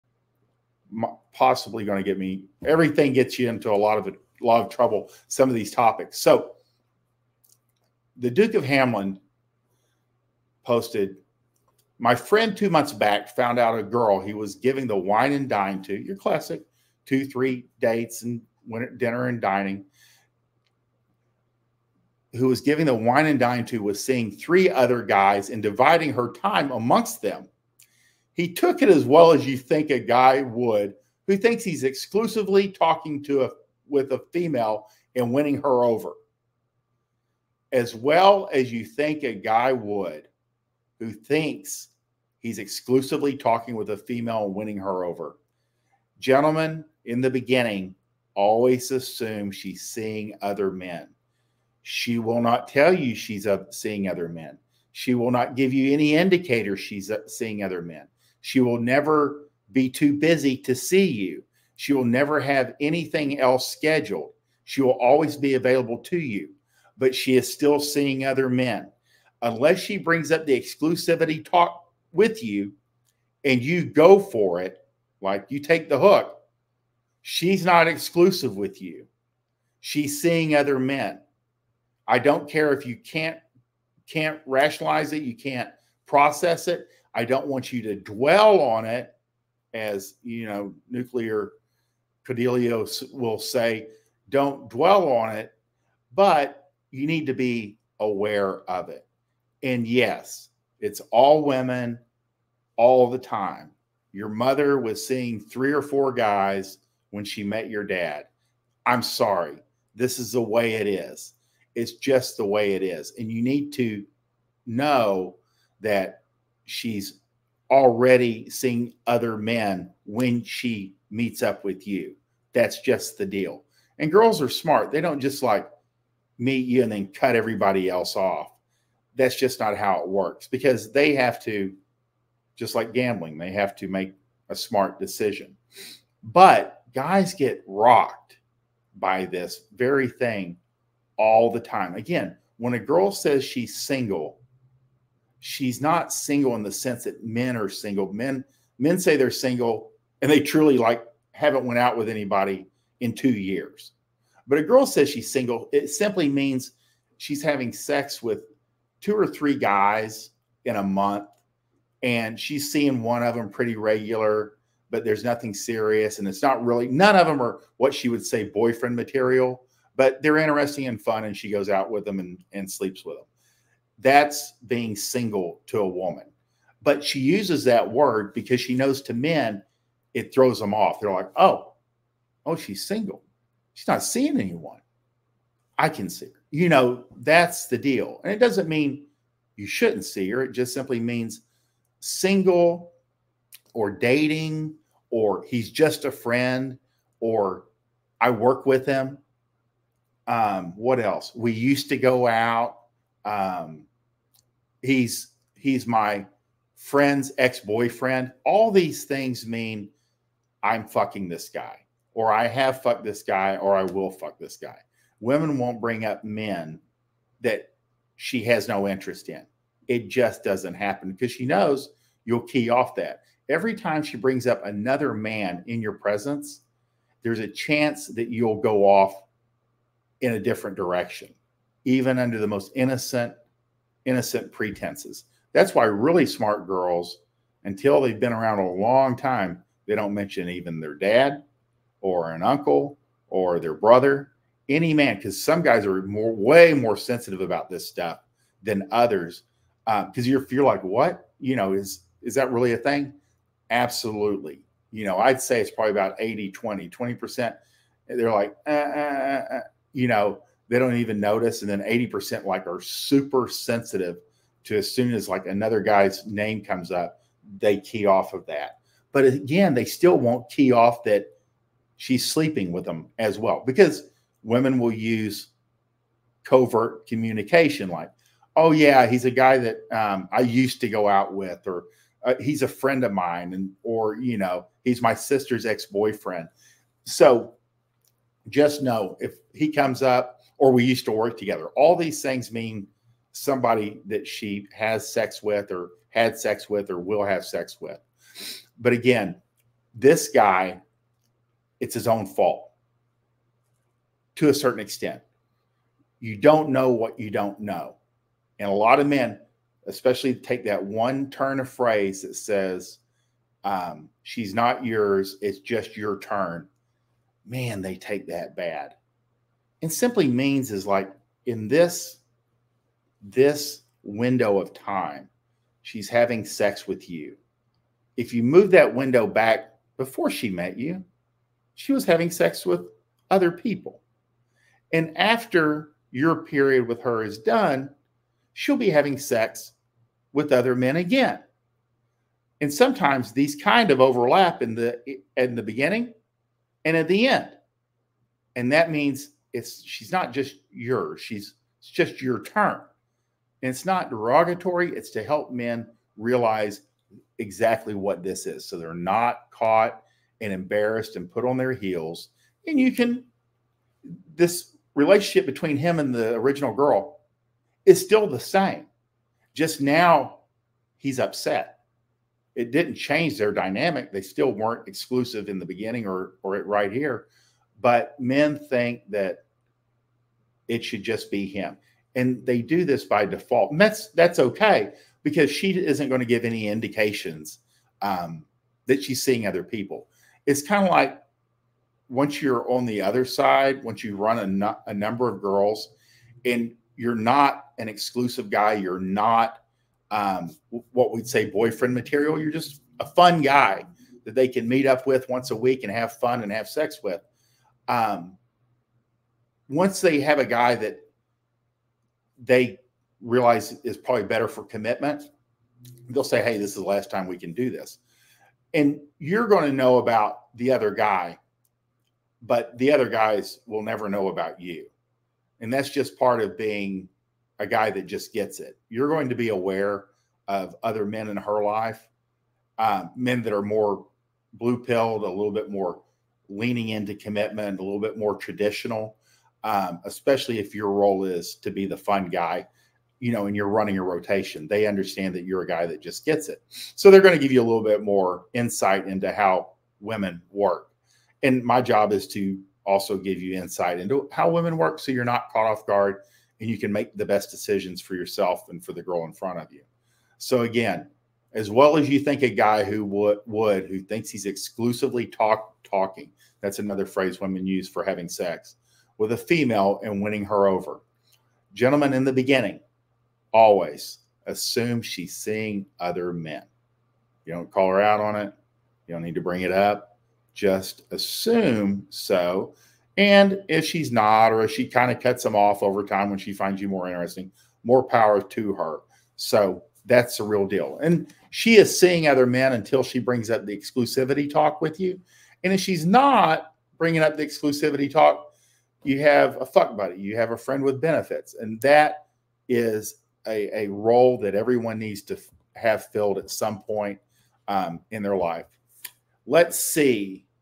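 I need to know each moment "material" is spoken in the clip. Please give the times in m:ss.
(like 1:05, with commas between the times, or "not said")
2:48, 6:41.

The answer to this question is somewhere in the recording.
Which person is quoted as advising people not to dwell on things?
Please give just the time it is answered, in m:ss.
1:32.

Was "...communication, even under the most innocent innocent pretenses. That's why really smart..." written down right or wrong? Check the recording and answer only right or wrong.
wrong.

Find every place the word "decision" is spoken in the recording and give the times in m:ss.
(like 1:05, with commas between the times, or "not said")
2:14, 7:37.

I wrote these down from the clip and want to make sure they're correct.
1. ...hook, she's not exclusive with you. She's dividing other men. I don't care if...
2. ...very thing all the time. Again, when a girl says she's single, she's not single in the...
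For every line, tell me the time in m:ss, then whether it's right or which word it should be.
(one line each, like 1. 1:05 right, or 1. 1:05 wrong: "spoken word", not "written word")
1. 1:15 wrong: "seeing", not "dividing"
2. 2:19 right.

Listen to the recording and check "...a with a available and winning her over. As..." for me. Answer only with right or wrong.
wrong.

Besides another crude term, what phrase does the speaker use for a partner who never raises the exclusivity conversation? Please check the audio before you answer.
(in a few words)
Friend with benefits.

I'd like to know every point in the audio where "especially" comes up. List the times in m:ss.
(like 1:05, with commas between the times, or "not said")
5:09, 7:20.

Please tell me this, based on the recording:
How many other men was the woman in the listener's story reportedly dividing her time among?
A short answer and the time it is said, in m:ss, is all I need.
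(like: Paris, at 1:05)
3, at 0:24.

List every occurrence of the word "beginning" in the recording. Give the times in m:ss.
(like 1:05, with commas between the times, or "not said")
0:47, 5:45, 6:15, 7:52.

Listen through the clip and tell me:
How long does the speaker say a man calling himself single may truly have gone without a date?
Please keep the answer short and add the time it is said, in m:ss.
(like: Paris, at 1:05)
2 years, at 2:33.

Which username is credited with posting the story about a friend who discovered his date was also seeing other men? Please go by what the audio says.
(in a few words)
Duke of Hamlin.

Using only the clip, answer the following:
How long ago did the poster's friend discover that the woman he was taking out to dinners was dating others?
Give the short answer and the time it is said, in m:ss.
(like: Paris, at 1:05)
Two months, at 0:12.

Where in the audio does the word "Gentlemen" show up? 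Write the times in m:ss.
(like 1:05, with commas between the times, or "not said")
0:46, 7:51.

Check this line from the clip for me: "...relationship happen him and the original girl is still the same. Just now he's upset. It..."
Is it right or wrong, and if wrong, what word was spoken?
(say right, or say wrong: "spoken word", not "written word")
wrong: "between", not "happen".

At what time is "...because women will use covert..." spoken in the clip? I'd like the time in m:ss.
4:33.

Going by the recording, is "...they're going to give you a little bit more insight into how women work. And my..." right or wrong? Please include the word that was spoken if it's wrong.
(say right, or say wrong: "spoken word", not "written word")
right.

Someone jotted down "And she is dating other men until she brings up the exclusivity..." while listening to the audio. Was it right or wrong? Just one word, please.
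wrong.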